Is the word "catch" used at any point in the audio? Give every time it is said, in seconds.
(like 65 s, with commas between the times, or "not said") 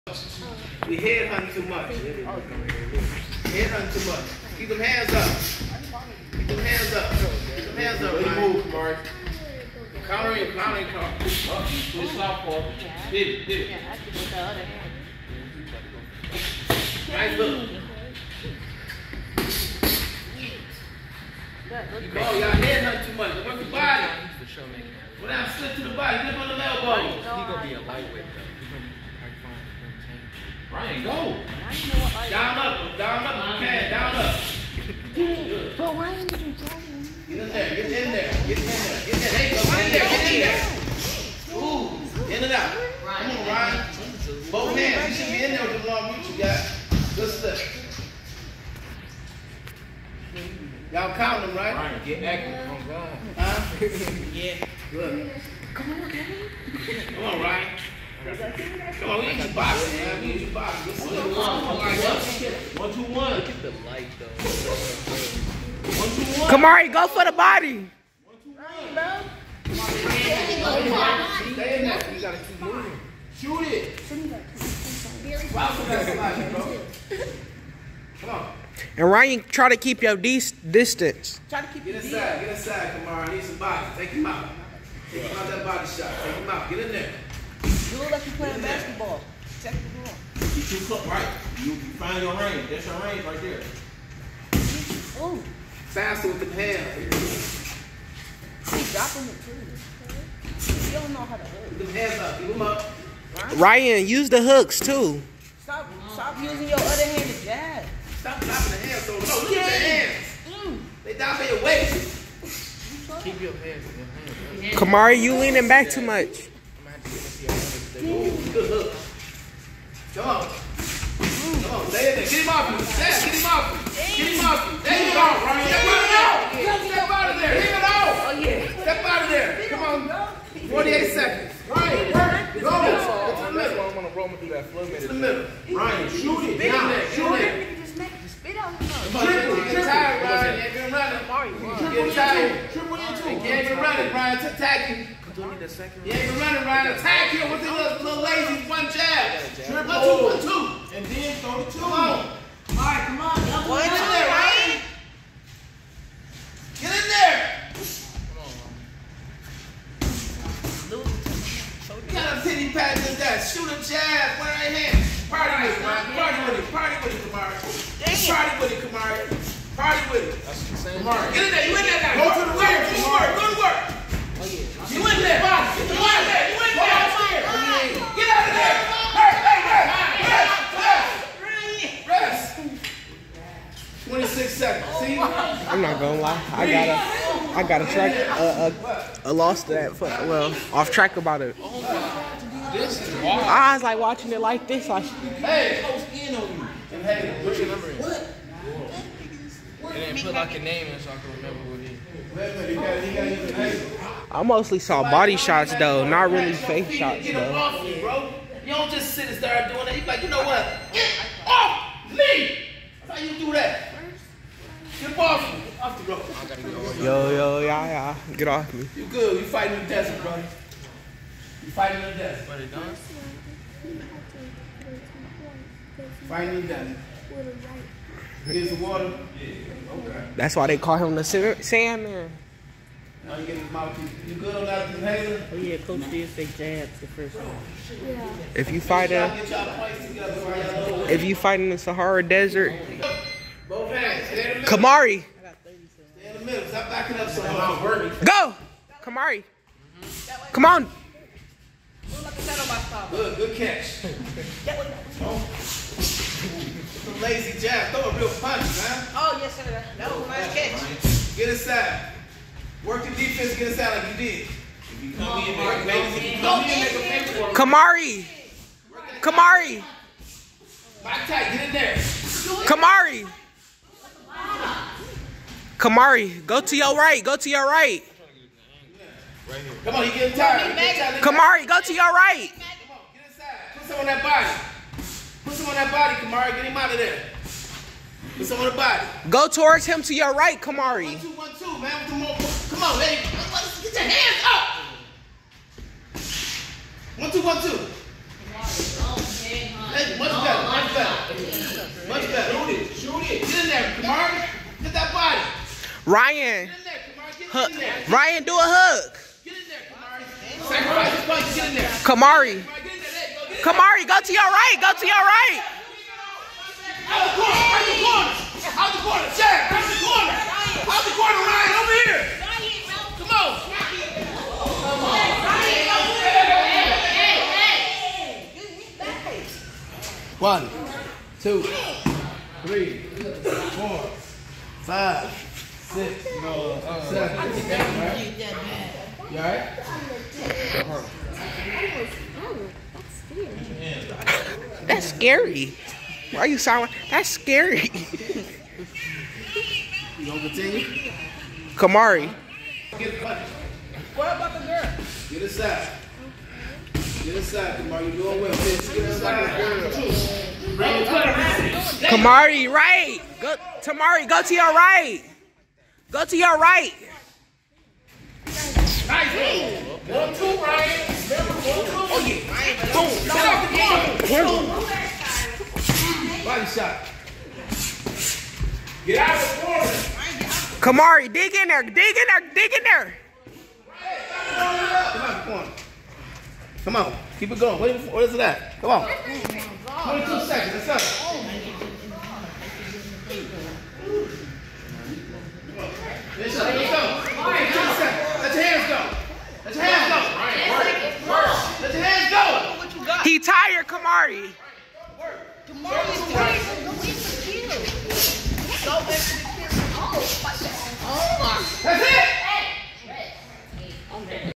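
253 s, 260 s.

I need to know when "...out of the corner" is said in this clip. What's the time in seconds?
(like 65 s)
379 s.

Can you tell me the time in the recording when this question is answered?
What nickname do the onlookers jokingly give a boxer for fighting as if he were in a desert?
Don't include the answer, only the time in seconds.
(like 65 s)
231 s.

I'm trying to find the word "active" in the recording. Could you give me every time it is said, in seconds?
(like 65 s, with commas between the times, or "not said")
52 s.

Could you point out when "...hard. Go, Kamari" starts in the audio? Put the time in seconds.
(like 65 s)
247 s.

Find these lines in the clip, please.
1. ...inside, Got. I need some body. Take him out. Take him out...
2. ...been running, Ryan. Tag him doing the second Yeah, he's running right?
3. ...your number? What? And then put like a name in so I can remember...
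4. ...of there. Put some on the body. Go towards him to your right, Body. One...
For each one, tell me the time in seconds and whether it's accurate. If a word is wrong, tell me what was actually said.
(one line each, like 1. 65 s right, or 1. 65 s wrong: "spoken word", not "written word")
1. 82 s wrong: "Kamari", not "Got"
2. 143 s right
3. 197 s right
4. 286 s wrong: "Kamari", not "Body".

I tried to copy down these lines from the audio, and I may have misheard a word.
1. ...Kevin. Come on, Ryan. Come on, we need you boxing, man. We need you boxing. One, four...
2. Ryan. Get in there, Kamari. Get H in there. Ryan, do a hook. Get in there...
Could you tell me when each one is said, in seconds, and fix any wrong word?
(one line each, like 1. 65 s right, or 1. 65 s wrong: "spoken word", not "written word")
1. 56 s wrong: "two", not "four"
2. 306 s right.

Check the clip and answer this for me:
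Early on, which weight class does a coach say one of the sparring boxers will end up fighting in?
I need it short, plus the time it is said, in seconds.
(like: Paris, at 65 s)
Lightweight, at 27 s.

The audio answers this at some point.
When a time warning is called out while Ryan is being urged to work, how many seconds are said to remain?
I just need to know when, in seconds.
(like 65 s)
130 s.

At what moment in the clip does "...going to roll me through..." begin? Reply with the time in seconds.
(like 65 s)
133 s.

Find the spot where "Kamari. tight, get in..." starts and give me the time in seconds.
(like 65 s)
269 s.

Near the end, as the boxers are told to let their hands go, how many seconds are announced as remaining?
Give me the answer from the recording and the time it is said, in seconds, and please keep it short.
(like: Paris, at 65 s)
22 seconds, at 389 s.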